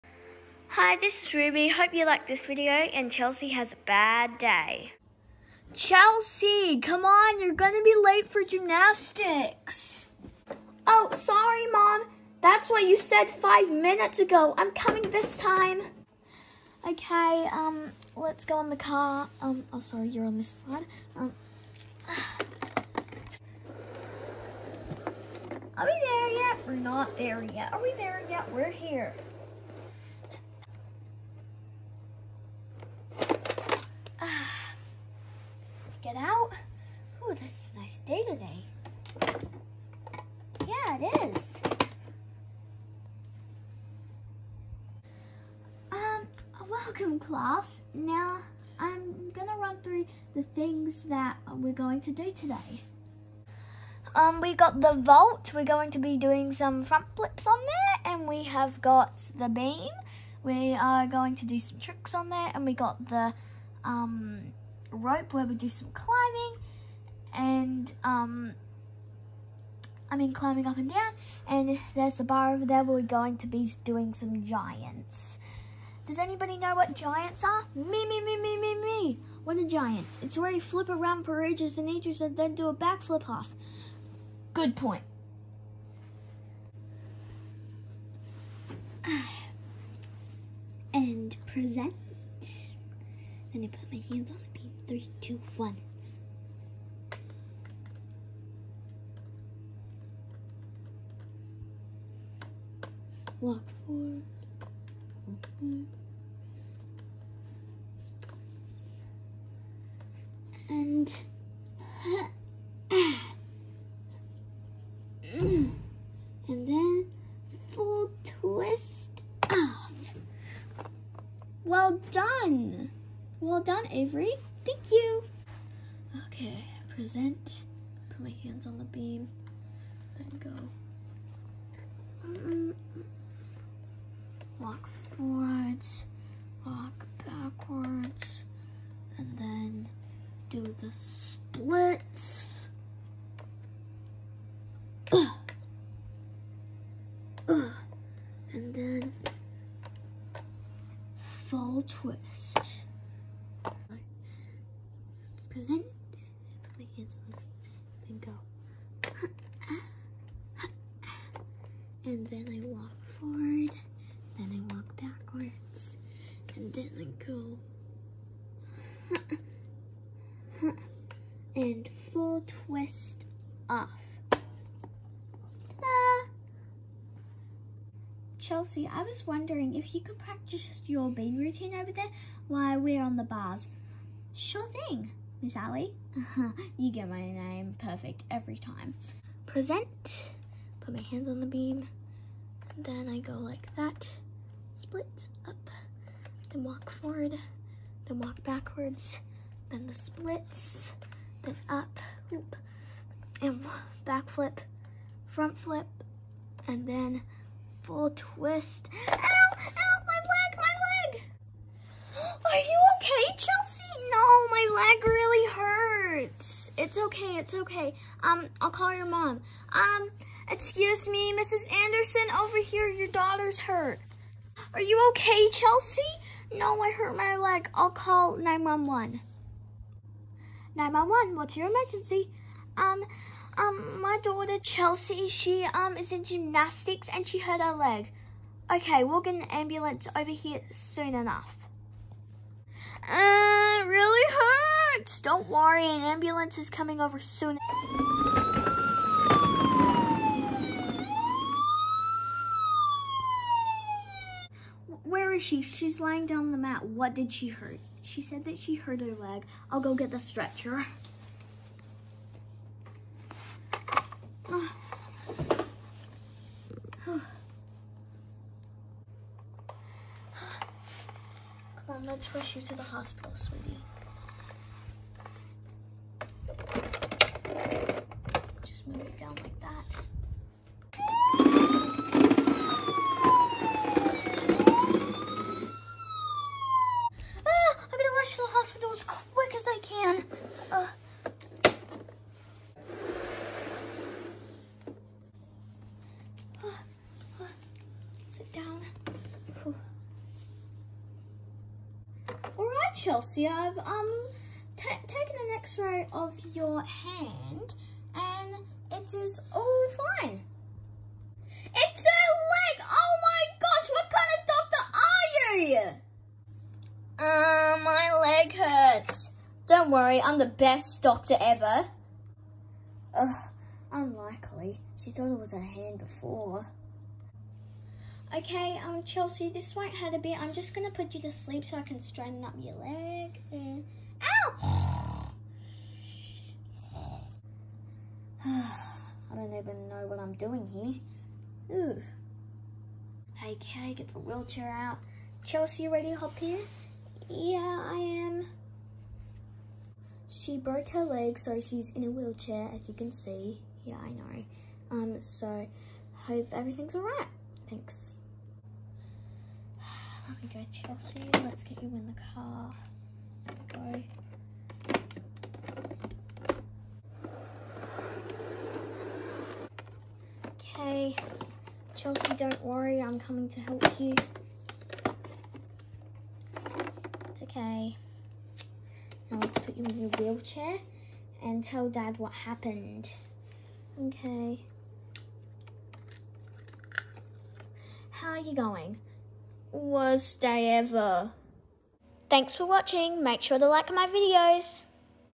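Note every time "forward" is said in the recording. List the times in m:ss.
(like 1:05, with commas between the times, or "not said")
1:43, 2:15, 2:43, 3:16.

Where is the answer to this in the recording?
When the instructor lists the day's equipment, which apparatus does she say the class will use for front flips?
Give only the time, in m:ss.
0:54.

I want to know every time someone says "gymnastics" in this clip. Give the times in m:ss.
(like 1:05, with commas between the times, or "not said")
0:08, 3:56.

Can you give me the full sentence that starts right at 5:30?
I'm just going to put you to sleep so I can straighten up your leg.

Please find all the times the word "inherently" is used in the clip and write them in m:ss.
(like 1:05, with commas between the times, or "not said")
not said.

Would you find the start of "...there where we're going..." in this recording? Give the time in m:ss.
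1:12.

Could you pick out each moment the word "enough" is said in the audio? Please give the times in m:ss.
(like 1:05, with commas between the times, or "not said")
4:01.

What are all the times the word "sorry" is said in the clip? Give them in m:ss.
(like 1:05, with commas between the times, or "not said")
0:11, 0:19.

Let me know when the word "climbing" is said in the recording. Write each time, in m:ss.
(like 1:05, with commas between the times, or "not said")
1:05, 1:10.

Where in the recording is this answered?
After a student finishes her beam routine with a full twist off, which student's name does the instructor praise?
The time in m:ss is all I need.
2:03.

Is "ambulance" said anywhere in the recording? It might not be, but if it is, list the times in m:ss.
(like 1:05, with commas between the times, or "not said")
3:59, 4:06.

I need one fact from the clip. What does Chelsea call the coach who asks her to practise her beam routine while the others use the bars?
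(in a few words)
Miss Allie.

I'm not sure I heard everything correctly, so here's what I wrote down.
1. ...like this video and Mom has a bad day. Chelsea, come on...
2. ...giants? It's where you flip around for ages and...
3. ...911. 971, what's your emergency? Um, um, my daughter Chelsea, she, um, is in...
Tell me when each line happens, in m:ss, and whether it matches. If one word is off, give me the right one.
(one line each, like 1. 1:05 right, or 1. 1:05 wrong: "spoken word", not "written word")
1. 0:02 wrong: "Chelsea", not "Mom"
2. 1:19 right
3. 3:48 wrong: "911", not "971".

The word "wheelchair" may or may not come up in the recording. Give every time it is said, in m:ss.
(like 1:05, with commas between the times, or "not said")
5:44, 5:52, 6:20.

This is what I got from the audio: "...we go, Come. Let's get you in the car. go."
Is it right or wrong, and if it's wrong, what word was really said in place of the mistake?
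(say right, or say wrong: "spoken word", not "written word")
wrong: "Chelsea", not "Come".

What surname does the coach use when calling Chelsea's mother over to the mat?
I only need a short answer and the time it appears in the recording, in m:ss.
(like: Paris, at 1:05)
Anderson, at 3:41.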